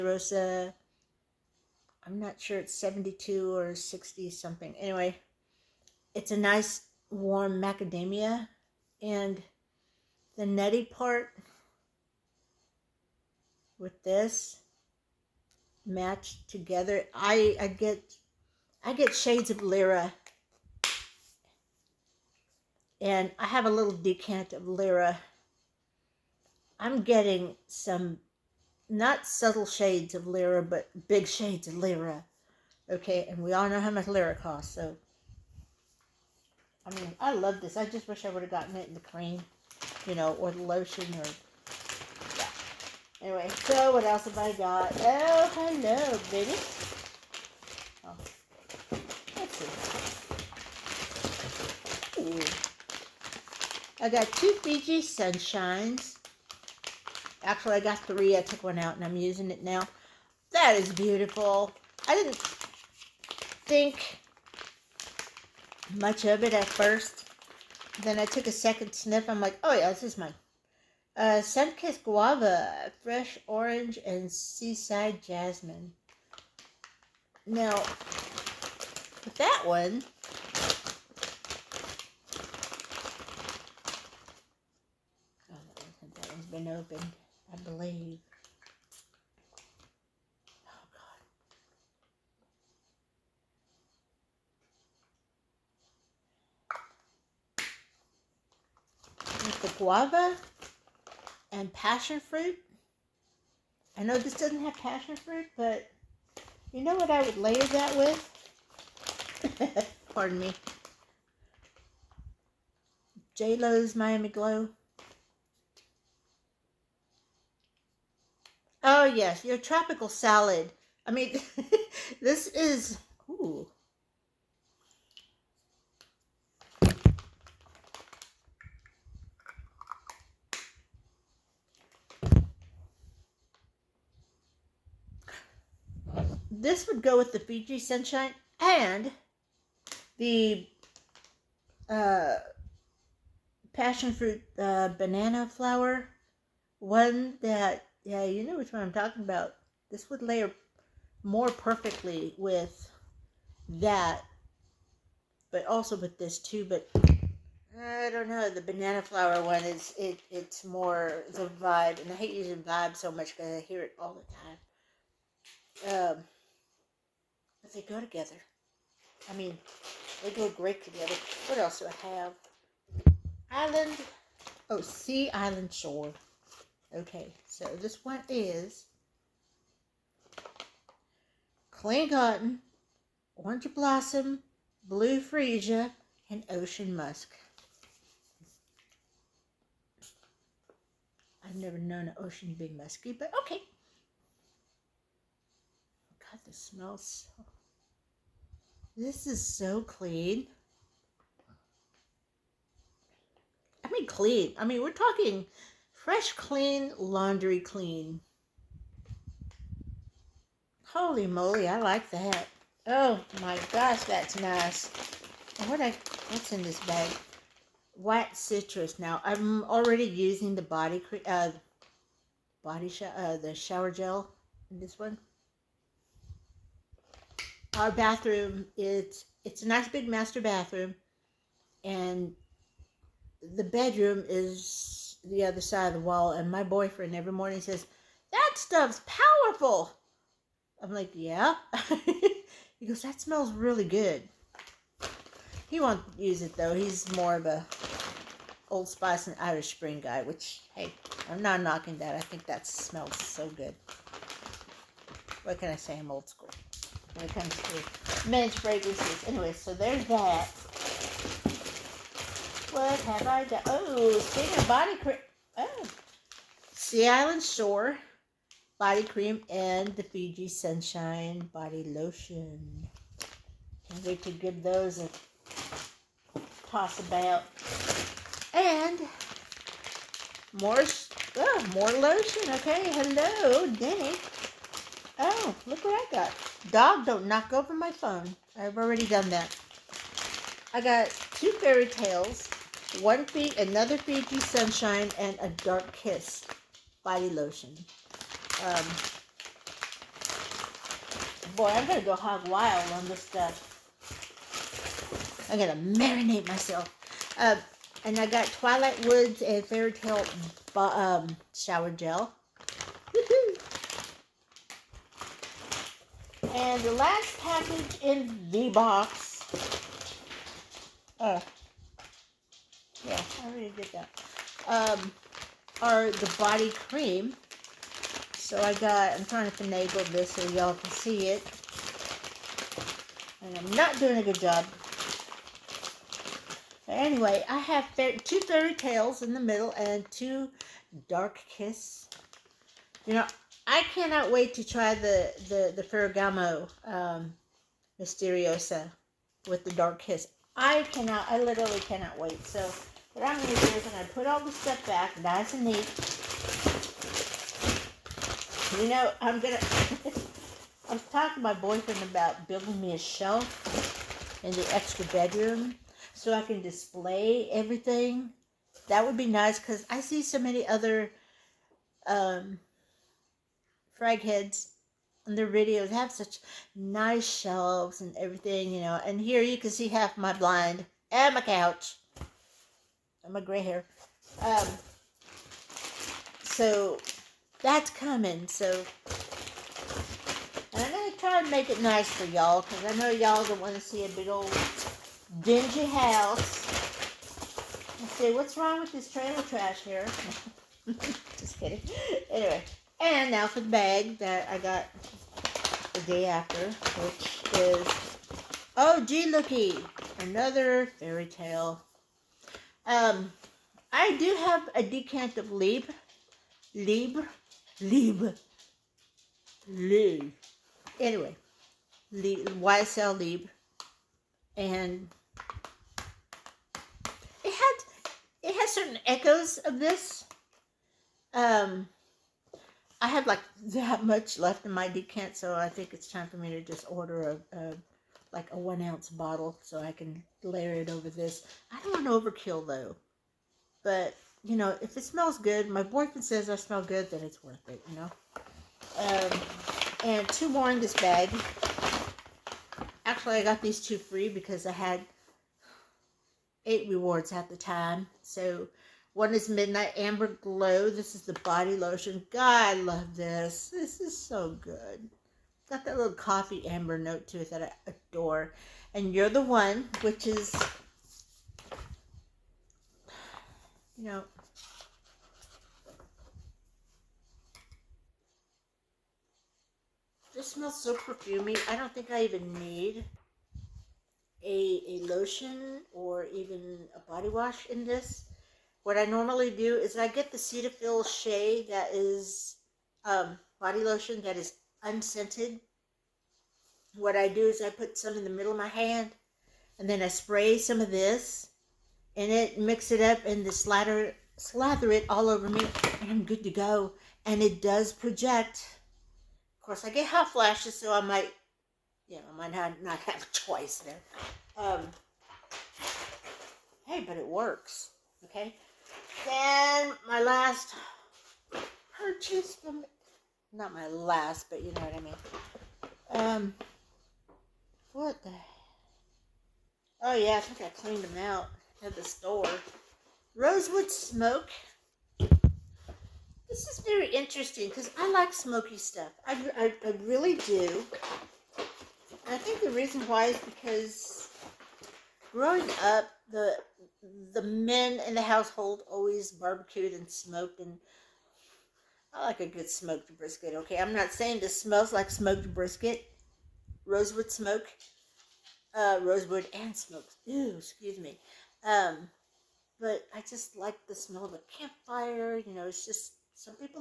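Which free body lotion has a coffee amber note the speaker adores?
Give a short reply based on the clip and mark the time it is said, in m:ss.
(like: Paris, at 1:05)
Midnight Amber Glow, at 7:39.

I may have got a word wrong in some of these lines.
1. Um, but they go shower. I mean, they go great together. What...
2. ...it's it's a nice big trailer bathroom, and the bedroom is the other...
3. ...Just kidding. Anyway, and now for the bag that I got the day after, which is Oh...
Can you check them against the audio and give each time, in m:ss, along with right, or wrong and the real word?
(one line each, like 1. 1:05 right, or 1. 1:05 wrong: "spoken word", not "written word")
1. 2:45 wrong: "together", not "shower"
2. 3:48 wrong: "master", not "trailer"
3. 6:41 right.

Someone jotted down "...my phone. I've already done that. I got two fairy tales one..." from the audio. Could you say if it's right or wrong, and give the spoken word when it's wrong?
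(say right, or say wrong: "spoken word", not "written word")
right.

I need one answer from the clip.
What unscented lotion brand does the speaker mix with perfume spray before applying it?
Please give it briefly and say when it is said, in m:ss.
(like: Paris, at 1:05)
Cetaphil, at 8:10.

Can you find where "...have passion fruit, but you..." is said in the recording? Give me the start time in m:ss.
1:44.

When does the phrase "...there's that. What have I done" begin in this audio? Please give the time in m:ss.
4:19.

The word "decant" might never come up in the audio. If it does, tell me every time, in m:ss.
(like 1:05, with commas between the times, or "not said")
0:23, 6:54, 7:14.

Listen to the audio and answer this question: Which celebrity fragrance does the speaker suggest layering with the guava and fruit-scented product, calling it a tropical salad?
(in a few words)
Miami Glow.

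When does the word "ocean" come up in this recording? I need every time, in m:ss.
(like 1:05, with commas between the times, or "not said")
3:06, 3:12.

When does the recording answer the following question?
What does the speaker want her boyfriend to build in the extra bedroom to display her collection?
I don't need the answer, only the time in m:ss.
6:02.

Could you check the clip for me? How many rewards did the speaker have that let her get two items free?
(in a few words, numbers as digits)
8.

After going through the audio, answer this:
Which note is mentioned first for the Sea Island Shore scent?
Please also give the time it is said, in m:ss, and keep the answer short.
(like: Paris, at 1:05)
Clean cotton, at 3:01.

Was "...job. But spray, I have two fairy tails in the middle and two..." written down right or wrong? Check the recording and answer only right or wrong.
wrong.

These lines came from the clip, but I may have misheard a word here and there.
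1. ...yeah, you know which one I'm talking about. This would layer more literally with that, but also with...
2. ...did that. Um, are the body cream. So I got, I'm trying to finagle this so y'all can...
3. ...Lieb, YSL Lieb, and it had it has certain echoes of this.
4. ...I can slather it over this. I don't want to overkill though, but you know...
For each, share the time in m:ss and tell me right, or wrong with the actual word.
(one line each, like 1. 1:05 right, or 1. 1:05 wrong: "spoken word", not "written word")
1. 2:28 wrong: "perfectly", not "literally"
2. 5:23 right
3. 7:02 right
4. 7:19 wrong: "layer", not "slather".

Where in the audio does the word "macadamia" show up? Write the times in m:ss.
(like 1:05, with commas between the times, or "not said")
0:07.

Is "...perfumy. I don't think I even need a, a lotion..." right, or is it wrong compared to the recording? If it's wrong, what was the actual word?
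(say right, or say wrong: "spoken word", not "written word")
right.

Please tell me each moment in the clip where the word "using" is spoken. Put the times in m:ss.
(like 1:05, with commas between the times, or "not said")
0:59, 2:42, 3:40.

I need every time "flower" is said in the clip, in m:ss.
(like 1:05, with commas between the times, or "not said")
2:25, 2:39.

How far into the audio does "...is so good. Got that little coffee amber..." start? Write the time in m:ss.
7:43.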